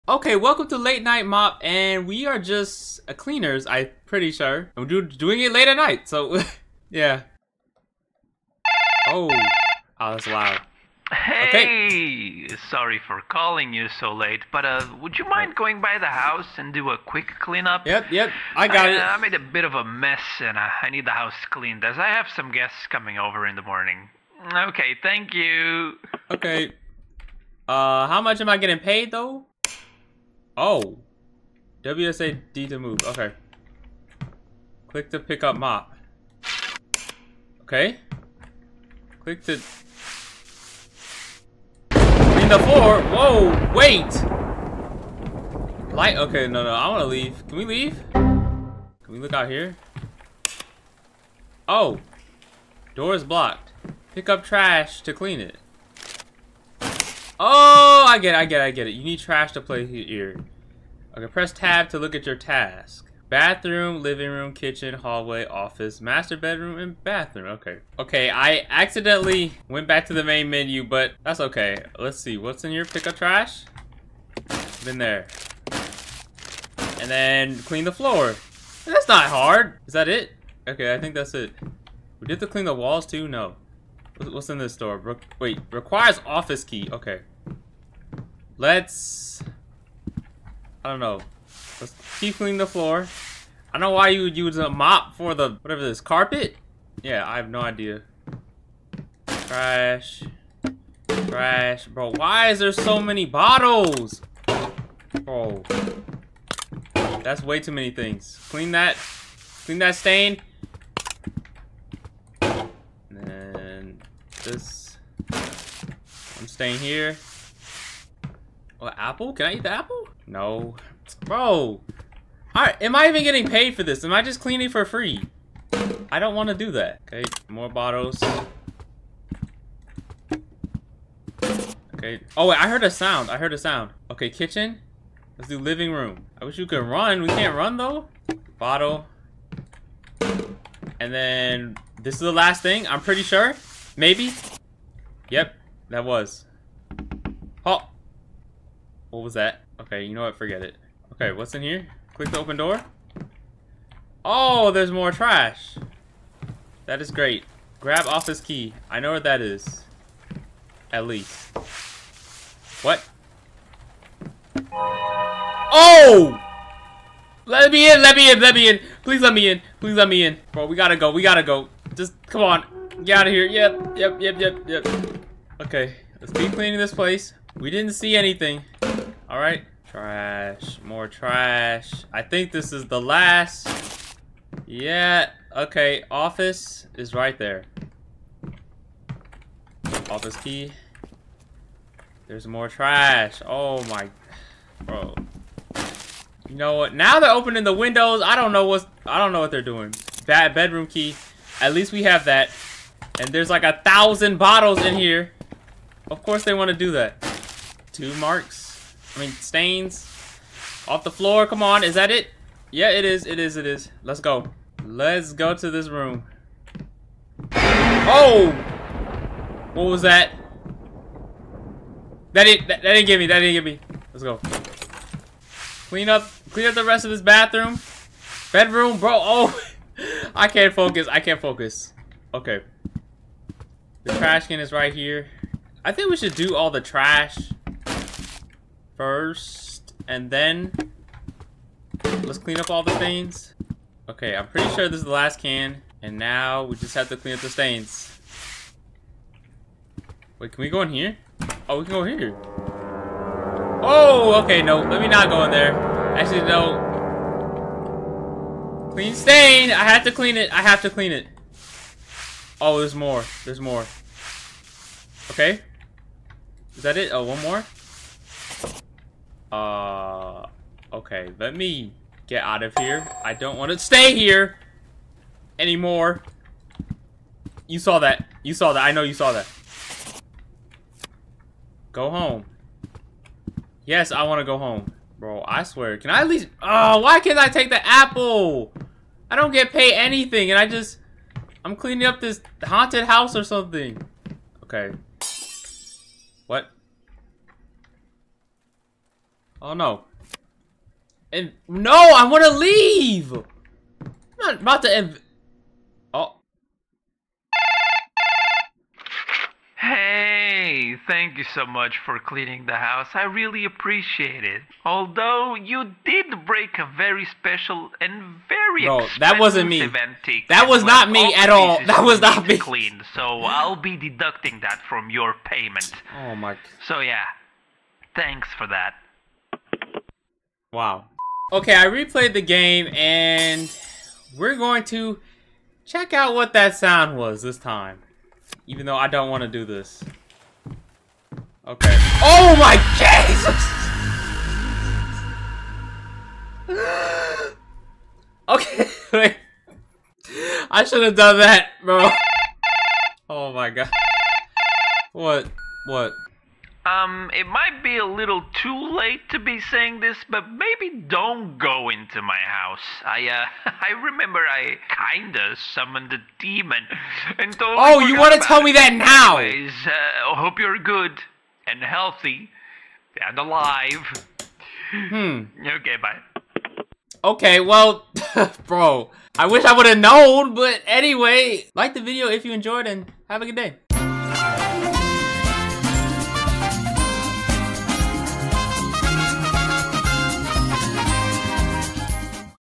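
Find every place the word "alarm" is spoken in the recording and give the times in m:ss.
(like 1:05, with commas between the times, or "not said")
not said.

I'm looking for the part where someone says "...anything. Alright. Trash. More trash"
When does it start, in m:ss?
2:58.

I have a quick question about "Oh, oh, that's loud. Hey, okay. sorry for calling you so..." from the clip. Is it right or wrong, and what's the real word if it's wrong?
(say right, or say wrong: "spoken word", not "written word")
right.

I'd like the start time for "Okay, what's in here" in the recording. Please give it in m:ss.
2:31.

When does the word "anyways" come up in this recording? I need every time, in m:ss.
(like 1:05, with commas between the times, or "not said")
6:09, 6:20.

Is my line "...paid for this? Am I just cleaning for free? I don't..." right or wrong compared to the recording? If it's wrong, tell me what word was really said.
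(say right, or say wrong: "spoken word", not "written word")
right.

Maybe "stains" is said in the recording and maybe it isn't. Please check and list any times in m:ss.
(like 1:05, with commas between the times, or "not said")
1:49, 3:29, 4:02, 4:07, 4:19.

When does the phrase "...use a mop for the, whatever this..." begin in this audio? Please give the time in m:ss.
1:34.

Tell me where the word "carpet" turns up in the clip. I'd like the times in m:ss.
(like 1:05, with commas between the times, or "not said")
1:36.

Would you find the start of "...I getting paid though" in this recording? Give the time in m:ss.
0:28.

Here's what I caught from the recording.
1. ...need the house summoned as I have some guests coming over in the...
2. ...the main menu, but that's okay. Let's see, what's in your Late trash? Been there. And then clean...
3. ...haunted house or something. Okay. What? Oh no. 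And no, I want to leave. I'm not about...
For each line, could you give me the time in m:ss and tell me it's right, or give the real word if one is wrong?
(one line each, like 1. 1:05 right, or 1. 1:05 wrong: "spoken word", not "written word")
1. 0:20 wrong: "cleaned", not "summoned"
2. 1:10 wrong: "Pick", not "Late"
3. 4:52 right.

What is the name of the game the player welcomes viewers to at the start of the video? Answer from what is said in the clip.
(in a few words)
Late Night Mop.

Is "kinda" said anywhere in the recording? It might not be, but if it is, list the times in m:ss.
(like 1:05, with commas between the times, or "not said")
6:05.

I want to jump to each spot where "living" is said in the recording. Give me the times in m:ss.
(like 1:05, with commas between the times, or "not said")
1:04, 2:15.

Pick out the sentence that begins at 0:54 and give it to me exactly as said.
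Pick up trash to clean it.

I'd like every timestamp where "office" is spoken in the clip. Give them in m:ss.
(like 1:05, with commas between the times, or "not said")
1:05, 1:26, 2:38, 3:06, 3:10.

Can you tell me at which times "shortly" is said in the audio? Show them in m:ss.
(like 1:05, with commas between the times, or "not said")
not said.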